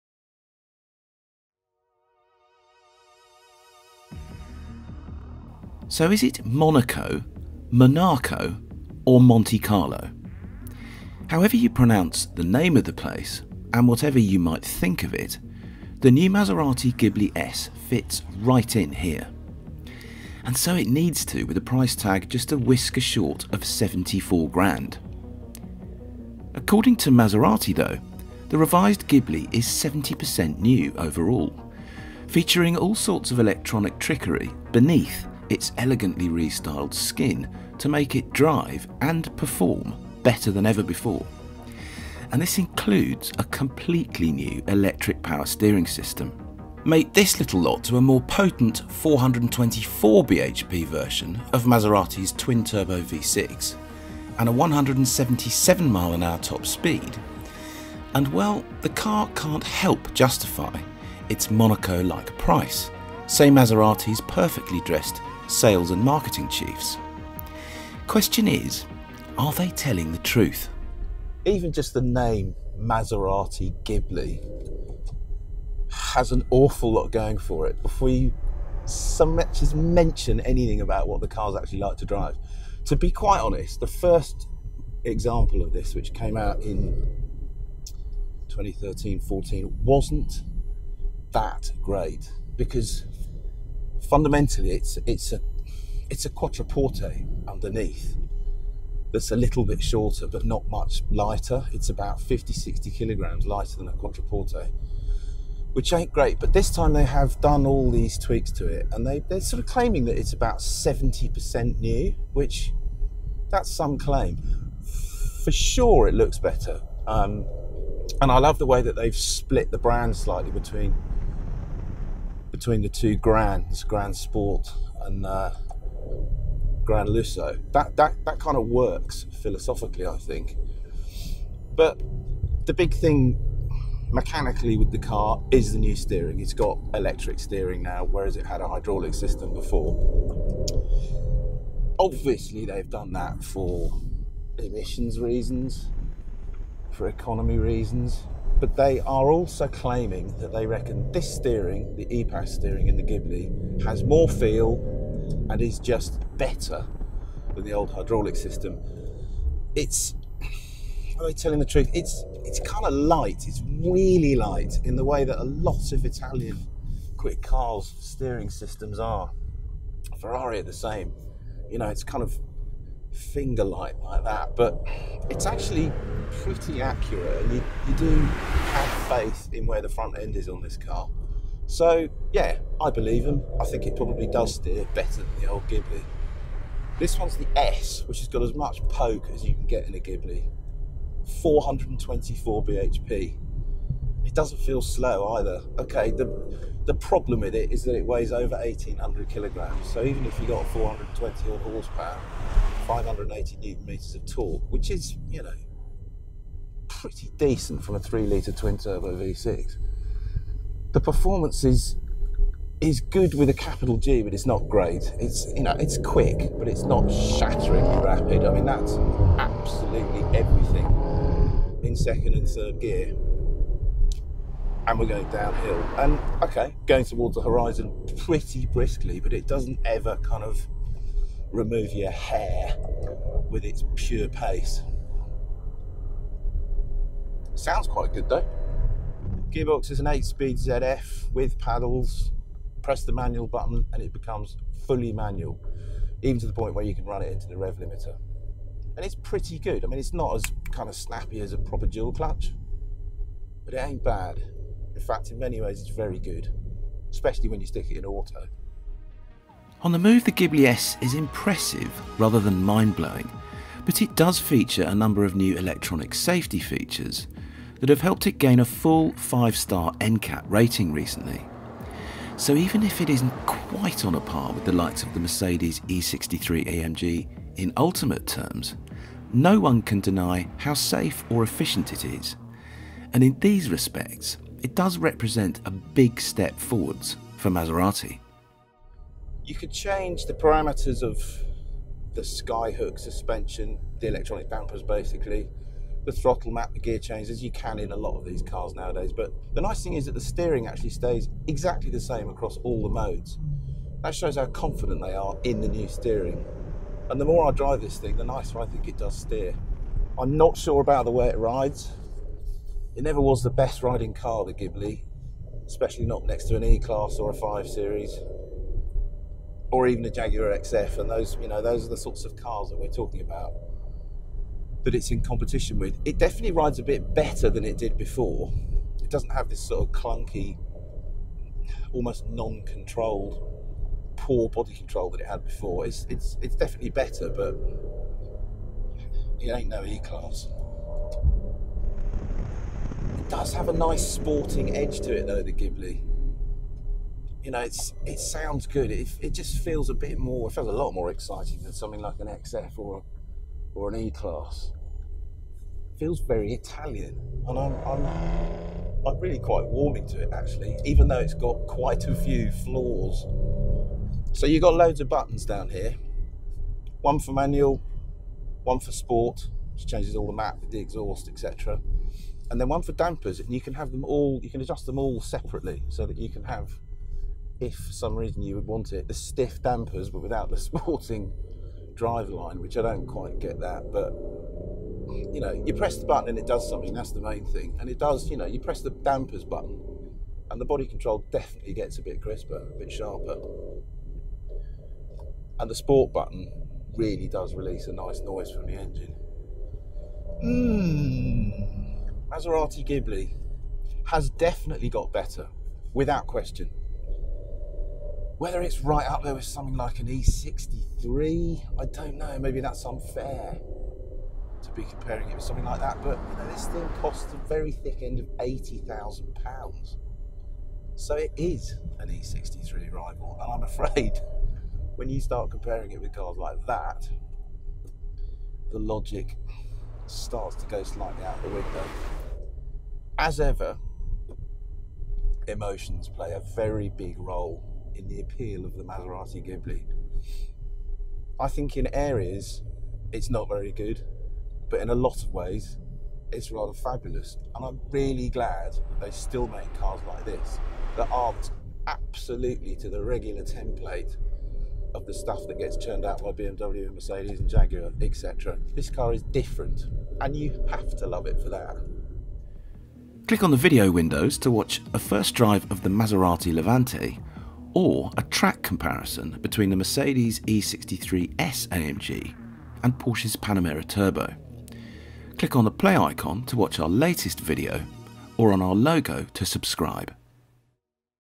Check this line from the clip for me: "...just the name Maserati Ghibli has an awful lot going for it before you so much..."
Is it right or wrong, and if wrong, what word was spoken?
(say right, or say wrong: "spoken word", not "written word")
right.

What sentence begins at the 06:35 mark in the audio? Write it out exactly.
And the sport button really does release a nice noise from the engine.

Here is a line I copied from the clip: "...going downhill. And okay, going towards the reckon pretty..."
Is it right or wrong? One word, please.
wrong.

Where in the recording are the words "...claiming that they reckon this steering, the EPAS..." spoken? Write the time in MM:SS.
02:29.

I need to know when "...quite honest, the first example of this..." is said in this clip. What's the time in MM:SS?
01:23.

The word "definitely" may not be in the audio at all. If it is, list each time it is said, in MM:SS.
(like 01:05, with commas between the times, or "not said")
05:26, 05:36, 06:31, 06:44.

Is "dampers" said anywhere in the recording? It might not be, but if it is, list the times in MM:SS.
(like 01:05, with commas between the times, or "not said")
04:54, 06:12, 06:19, 06:28.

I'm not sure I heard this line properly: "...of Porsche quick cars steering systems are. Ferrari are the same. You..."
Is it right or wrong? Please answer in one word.
wrong.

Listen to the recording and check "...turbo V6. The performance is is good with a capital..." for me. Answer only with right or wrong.
right.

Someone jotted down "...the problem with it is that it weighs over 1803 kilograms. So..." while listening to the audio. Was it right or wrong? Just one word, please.
wrong.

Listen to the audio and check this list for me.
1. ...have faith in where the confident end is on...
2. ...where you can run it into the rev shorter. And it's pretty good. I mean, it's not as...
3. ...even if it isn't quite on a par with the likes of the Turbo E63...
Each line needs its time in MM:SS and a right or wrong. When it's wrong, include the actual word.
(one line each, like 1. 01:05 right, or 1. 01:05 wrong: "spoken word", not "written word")
1. 02:58 wrong: "front", not "confident"
2. 04:06 wrong: "limiter", not "shorter"
3. 04:32 wrong: "Mercedes", not "Turbo".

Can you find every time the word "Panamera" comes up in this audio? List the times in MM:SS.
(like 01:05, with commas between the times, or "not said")
07:53.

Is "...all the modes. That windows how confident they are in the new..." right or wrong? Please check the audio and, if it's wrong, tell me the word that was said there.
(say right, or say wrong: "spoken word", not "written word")
wrong: "shows", not "windows".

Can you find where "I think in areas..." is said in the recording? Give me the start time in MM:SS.
07:21.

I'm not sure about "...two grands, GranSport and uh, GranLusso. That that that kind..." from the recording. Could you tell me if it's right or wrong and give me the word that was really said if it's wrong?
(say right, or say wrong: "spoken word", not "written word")
right.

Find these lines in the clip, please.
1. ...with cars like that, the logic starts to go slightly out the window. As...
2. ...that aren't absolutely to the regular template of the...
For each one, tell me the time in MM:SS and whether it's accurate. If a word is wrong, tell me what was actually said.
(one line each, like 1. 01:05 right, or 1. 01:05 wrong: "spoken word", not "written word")
1. 07:06 right
2. 07:30 right.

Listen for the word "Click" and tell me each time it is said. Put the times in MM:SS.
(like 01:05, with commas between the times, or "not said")
07:43, 07:55.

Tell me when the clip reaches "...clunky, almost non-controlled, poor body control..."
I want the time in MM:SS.
05:29.